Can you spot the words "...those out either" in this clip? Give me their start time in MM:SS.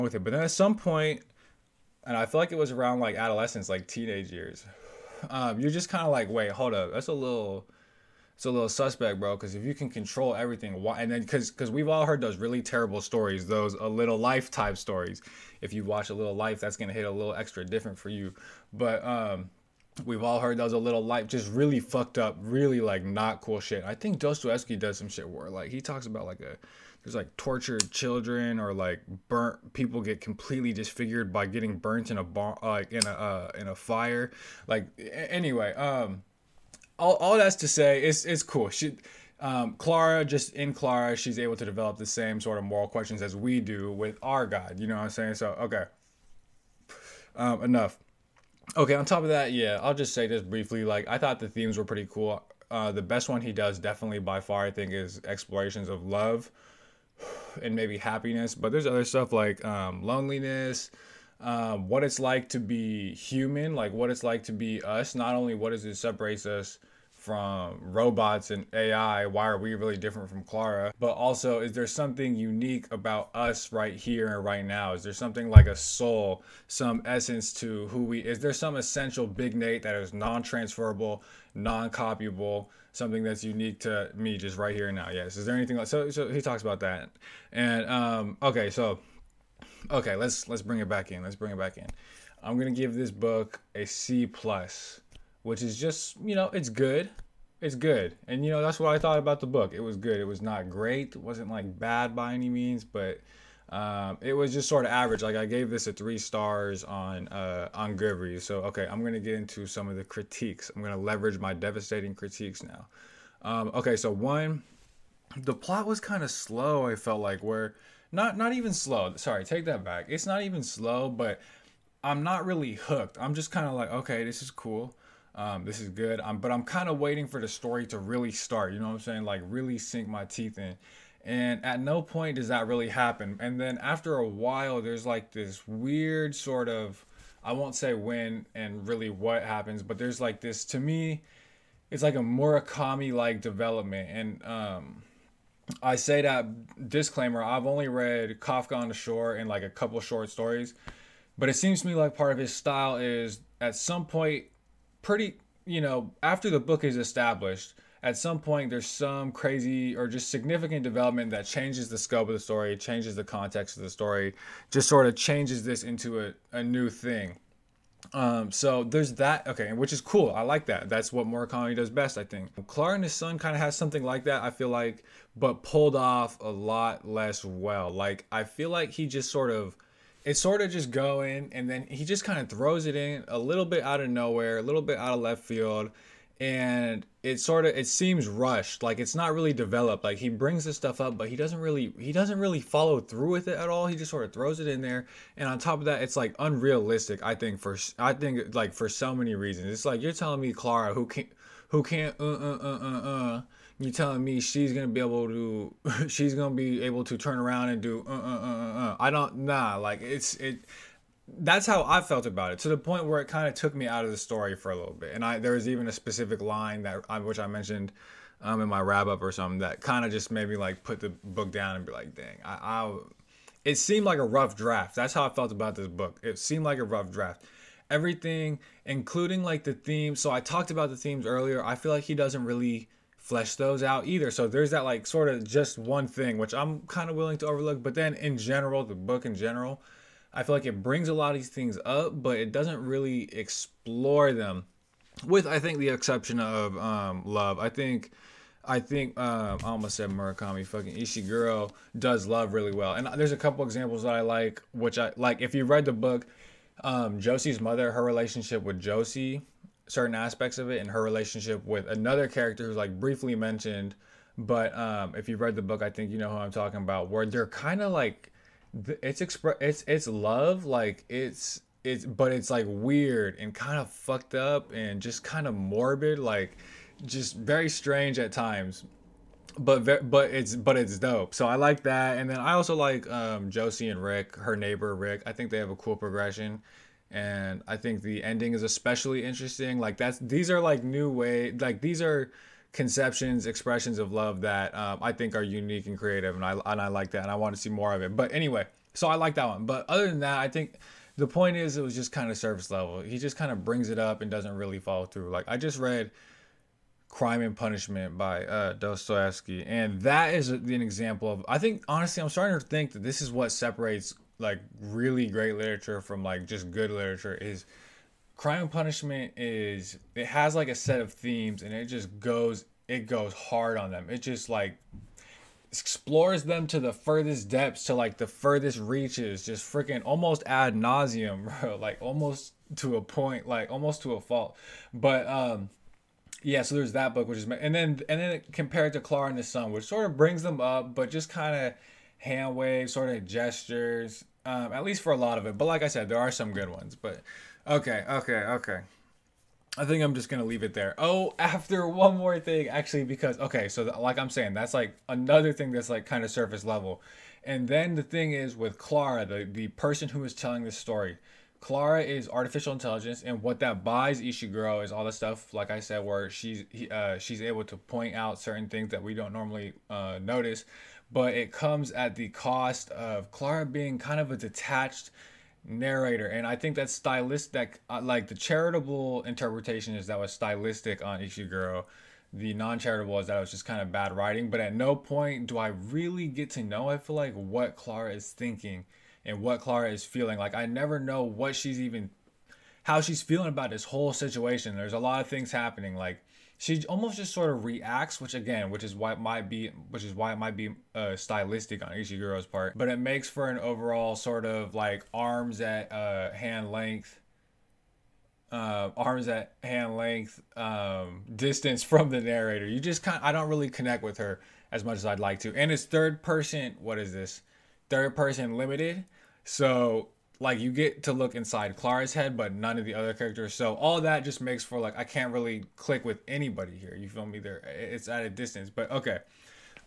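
03:53.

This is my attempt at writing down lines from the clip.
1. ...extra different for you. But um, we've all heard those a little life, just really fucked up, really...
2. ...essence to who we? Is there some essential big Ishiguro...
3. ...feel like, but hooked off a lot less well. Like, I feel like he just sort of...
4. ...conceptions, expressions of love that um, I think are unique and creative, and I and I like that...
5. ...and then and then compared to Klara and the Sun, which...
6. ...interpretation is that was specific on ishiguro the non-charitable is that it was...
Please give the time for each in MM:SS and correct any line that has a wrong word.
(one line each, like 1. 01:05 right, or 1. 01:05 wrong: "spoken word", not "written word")
1. 00:17 right
2. 01:17 wrong: "Nate", not "Ishiguro"
3. 02:54 wrong: "pulled", not "hooked"
4. 04:52 right
5. 05:37 right
6. 06:19 wrong: "stylistic", not "specific".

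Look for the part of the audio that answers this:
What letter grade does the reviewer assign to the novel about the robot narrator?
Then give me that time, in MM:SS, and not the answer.
01:33.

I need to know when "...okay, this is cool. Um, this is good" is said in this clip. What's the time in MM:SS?
02:03.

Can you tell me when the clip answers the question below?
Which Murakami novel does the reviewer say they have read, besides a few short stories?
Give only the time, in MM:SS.
02:28.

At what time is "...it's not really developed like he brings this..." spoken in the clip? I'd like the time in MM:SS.
03:08.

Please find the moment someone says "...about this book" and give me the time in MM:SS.
03:45.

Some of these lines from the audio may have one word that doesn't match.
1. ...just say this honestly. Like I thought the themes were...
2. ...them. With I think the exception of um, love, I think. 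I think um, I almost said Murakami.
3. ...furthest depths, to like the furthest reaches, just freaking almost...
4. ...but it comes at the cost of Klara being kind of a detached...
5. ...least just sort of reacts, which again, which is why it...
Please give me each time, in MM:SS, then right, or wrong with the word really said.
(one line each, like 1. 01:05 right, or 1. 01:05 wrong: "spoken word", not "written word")
1. 00:49 wrong: "briefly", not "honestly"
2. 04:04 right
3. 05:26 right
4. 06:11 right
5. 06:36 wrong: "almost", not "least".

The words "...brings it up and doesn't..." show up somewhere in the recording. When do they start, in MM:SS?
05:03.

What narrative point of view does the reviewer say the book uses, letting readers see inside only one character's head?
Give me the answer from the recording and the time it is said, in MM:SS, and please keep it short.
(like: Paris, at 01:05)
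Third person limited, at 06:57.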